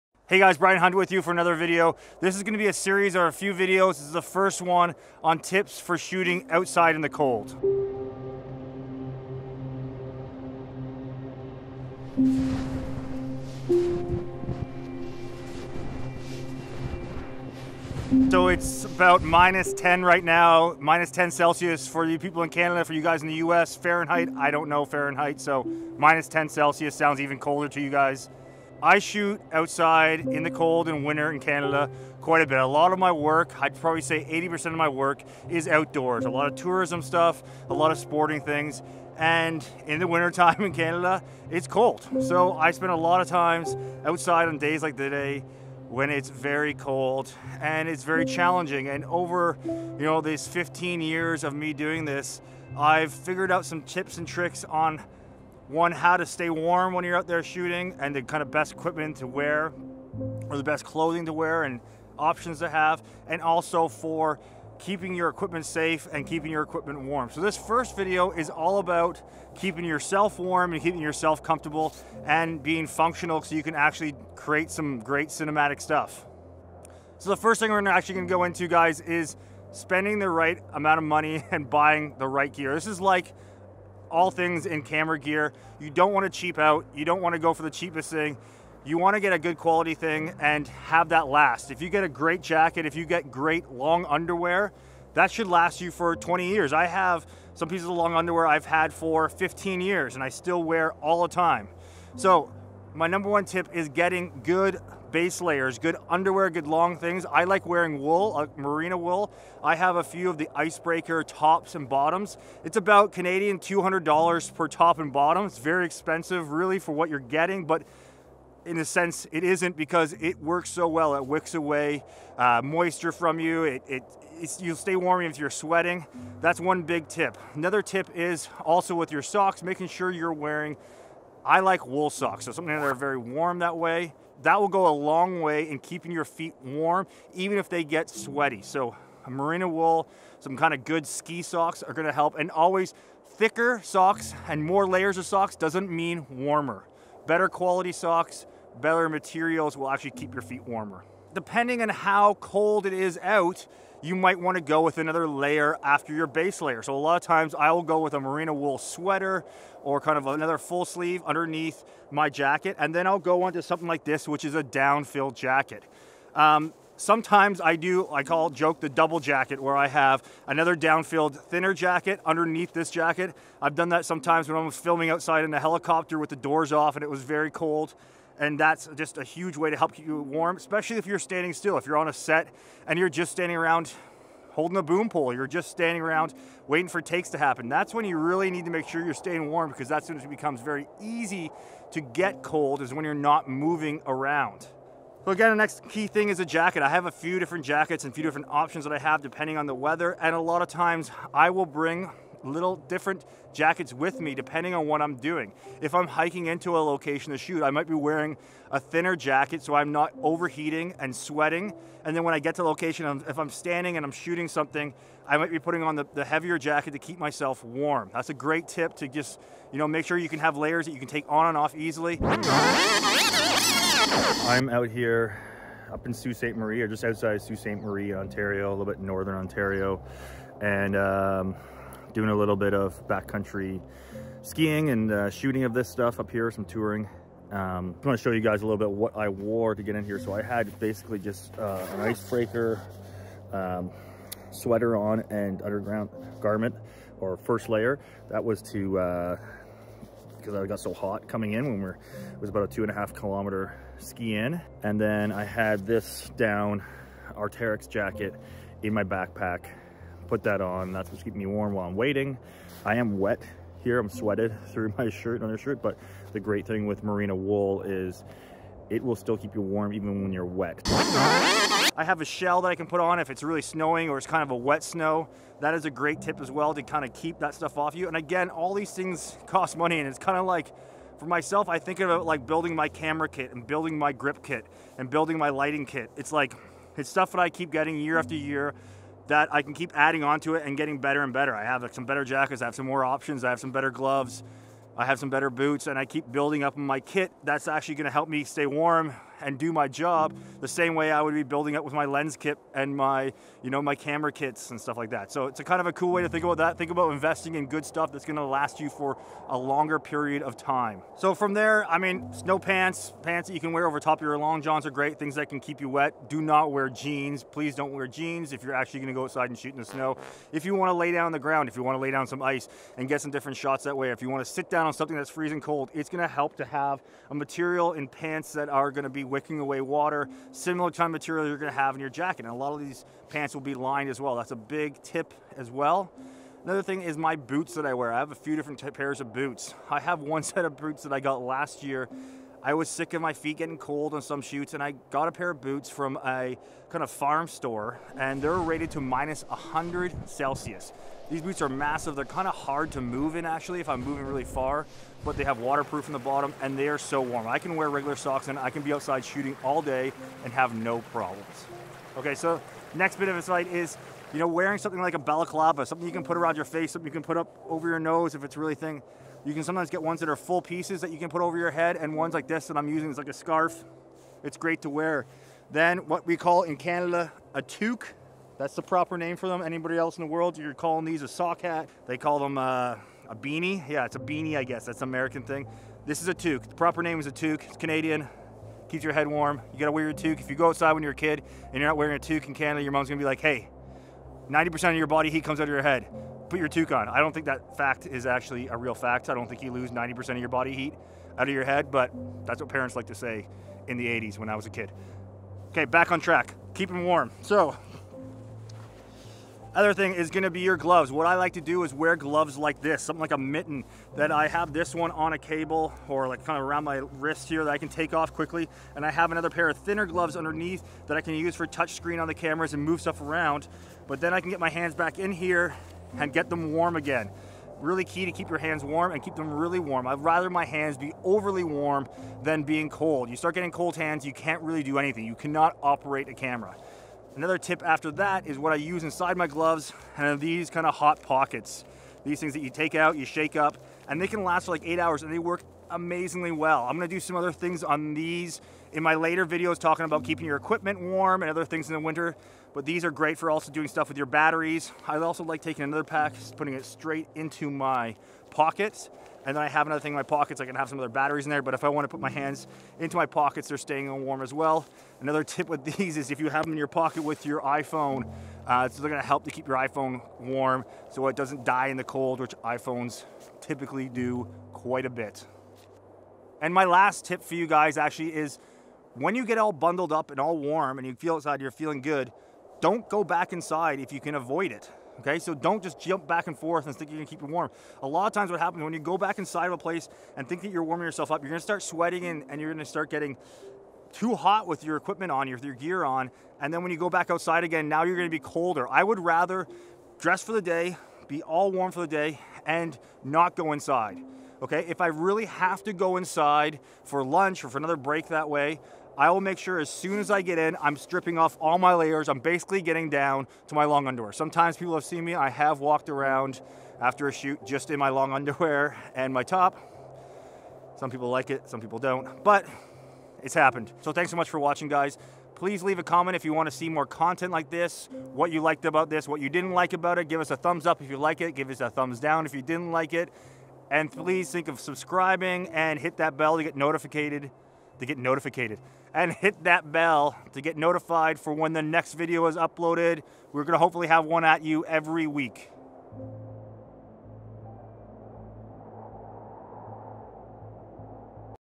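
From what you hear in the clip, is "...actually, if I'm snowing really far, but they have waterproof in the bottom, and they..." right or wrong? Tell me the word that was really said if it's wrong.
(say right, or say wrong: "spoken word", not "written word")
wrong: "moving", not "snowing".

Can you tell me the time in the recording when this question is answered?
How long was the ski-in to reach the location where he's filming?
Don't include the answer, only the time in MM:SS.
04:12.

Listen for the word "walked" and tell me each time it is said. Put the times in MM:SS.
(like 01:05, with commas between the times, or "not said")
08:35.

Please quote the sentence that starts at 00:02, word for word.
This is gonna be a series or a few videos.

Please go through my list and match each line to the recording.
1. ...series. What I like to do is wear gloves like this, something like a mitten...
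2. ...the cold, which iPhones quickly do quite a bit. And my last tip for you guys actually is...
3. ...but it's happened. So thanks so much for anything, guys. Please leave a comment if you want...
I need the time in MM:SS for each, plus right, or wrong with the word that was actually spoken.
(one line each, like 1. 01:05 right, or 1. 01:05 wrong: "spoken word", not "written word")
1. 06:50 wrong: "gloves", not "series"
2. 07:51 wrong: "typically", not "quickly"
3. 08:42 wrong: "watching", not "anything".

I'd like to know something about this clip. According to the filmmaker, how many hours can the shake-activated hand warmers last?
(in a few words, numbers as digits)
8 hours.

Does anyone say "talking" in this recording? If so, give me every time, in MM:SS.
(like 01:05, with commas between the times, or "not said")
07:29.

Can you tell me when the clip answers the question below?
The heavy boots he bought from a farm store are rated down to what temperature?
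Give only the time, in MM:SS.
05:49.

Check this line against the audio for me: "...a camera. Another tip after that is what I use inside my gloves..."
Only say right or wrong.
right.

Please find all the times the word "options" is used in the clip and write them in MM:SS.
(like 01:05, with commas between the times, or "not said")
01:02, 03:18, 04:53.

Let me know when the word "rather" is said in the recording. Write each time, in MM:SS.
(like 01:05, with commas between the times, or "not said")
07:10, 08:19.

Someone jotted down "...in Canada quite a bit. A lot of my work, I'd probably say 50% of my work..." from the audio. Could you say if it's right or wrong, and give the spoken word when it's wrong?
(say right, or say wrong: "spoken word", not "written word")
wrong: "80", not "50".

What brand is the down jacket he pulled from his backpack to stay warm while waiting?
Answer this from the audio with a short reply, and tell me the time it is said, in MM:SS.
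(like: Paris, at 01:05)
Arc'teryx, at 04:17.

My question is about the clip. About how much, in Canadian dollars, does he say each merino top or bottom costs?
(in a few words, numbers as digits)
$200.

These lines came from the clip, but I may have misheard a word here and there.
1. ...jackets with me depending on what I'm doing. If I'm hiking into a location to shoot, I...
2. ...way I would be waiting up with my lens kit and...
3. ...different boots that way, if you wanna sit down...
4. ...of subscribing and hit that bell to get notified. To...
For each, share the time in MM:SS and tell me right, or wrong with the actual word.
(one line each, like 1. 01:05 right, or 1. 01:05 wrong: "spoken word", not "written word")
1. 03:23 right
2. 05:00 wrong: "building", not "waiting"
3. 05:23 wrong: "shots", not "boots"
4. 08:54 right.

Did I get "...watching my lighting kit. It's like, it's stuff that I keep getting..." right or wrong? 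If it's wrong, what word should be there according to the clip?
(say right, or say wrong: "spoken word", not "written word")
wrong: "building", not "watching".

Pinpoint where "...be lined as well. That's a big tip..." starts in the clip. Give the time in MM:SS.
05:33.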